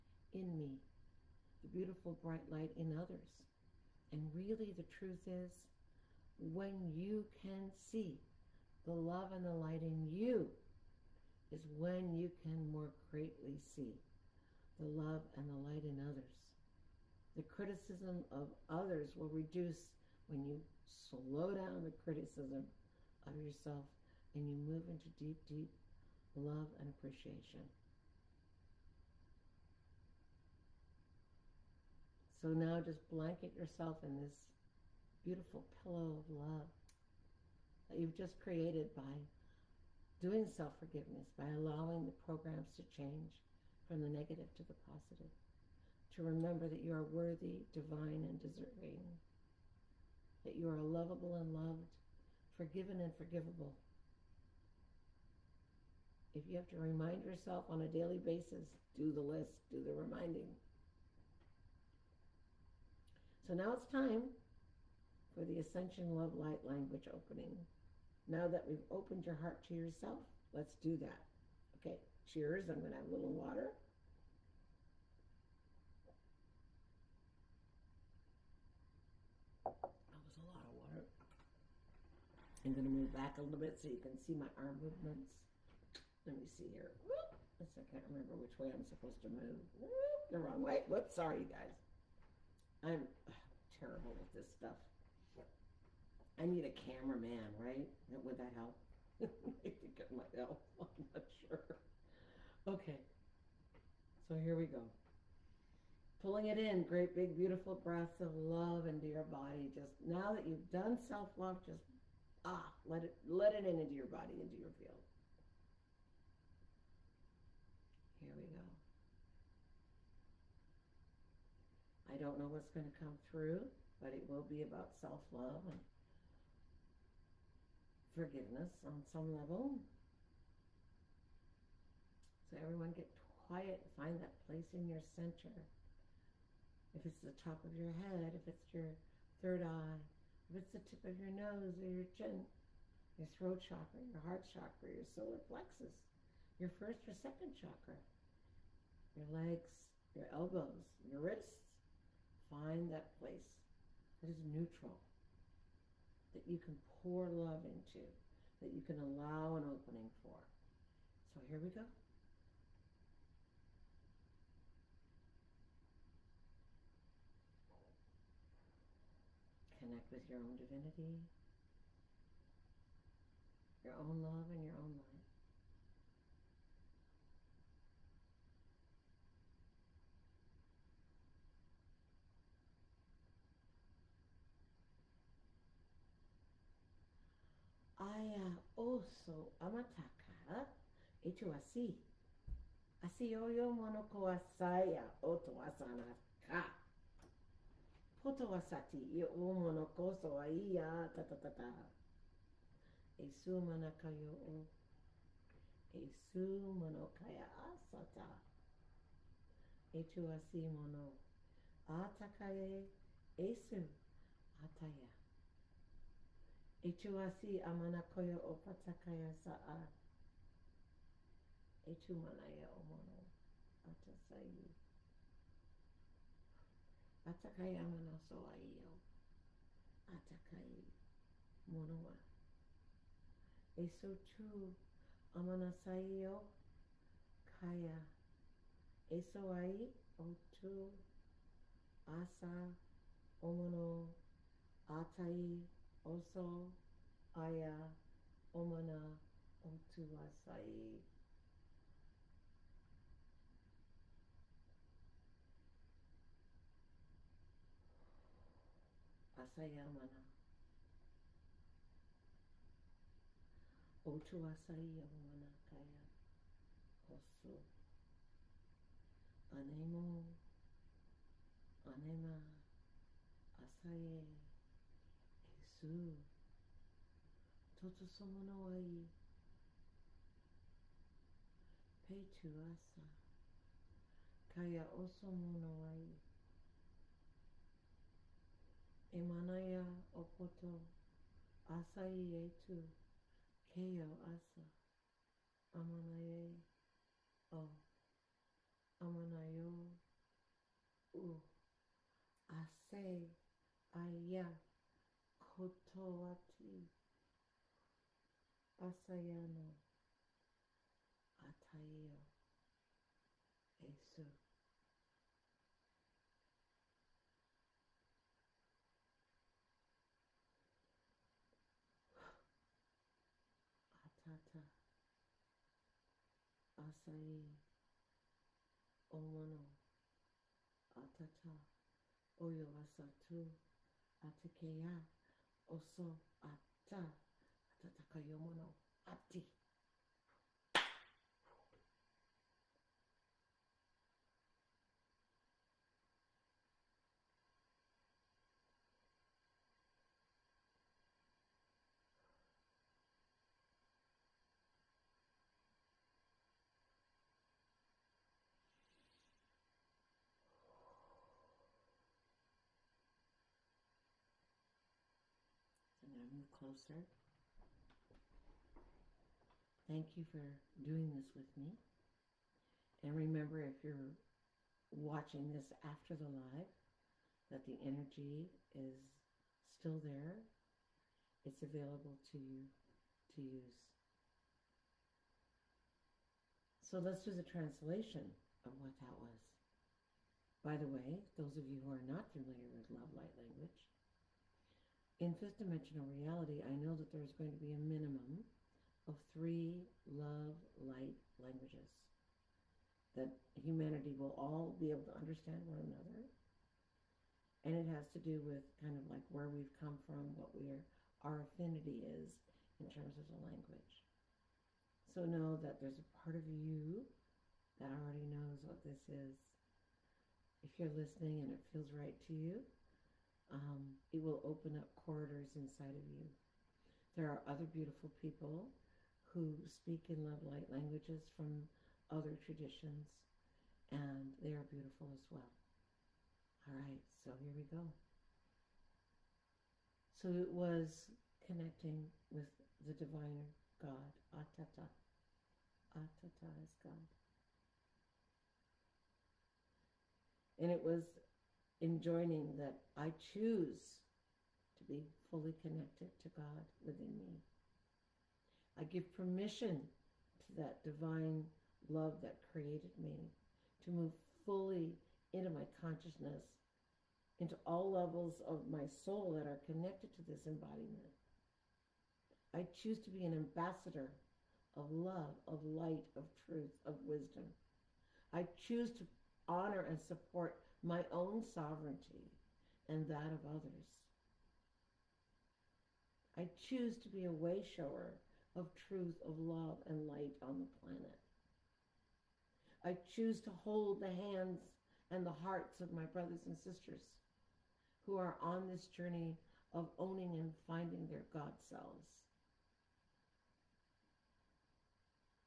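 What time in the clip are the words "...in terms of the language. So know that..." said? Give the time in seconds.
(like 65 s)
412 s.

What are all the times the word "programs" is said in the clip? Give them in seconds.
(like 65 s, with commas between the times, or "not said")
42 s.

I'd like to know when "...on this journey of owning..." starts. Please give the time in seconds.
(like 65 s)
498 s.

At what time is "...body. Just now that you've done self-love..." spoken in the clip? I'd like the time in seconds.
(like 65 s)
109 s.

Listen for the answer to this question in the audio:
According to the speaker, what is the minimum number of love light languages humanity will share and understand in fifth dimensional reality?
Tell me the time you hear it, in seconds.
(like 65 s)
399 s.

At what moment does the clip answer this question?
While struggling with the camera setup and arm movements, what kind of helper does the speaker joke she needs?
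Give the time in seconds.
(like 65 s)
96 s.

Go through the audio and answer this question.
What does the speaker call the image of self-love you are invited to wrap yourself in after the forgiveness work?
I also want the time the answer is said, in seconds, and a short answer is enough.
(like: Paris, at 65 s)
Beautiful pillow of love, at 35 s.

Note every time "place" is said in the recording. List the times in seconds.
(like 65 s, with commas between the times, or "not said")
134 s, 153 s.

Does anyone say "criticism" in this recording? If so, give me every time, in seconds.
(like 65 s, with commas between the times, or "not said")
17 s, 21 s.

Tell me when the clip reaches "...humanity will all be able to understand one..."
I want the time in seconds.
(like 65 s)
403 s.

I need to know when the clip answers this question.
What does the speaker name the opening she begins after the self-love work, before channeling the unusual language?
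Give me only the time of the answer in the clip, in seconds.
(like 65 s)
65 s.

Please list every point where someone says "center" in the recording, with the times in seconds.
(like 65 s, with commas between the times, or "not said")
135 s.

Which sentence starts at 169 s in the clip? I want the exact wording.
Connect with your own divinity, your own love, and your own light.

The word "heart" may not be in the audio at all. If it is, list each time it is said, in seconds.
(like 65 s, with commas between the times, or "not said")
69 s, 144 s, 495 s.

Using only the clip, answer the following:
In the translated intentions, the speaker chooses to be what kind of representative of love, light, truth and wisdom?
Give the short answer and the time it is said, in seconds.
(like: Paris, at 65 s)
An ambassador, at 473 s.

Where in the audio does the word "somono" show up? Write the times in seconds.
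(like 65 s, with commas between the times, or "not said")
278 s.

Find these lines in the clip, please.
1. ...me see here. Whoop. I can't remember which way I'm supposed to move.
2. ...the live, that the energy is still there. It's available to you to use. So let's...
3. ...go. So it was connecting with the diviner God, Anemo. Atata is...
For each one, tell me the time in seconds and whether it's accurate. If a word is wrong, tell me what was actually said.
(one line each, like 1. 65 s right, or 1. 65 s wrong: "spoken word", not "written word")
1. 86 s right
2. 376 s right
3. 437 s wrong: "Atata", not "Anemo".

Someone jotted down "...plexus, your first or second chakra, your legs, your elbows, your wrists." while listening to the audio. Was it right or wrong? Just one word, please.
right.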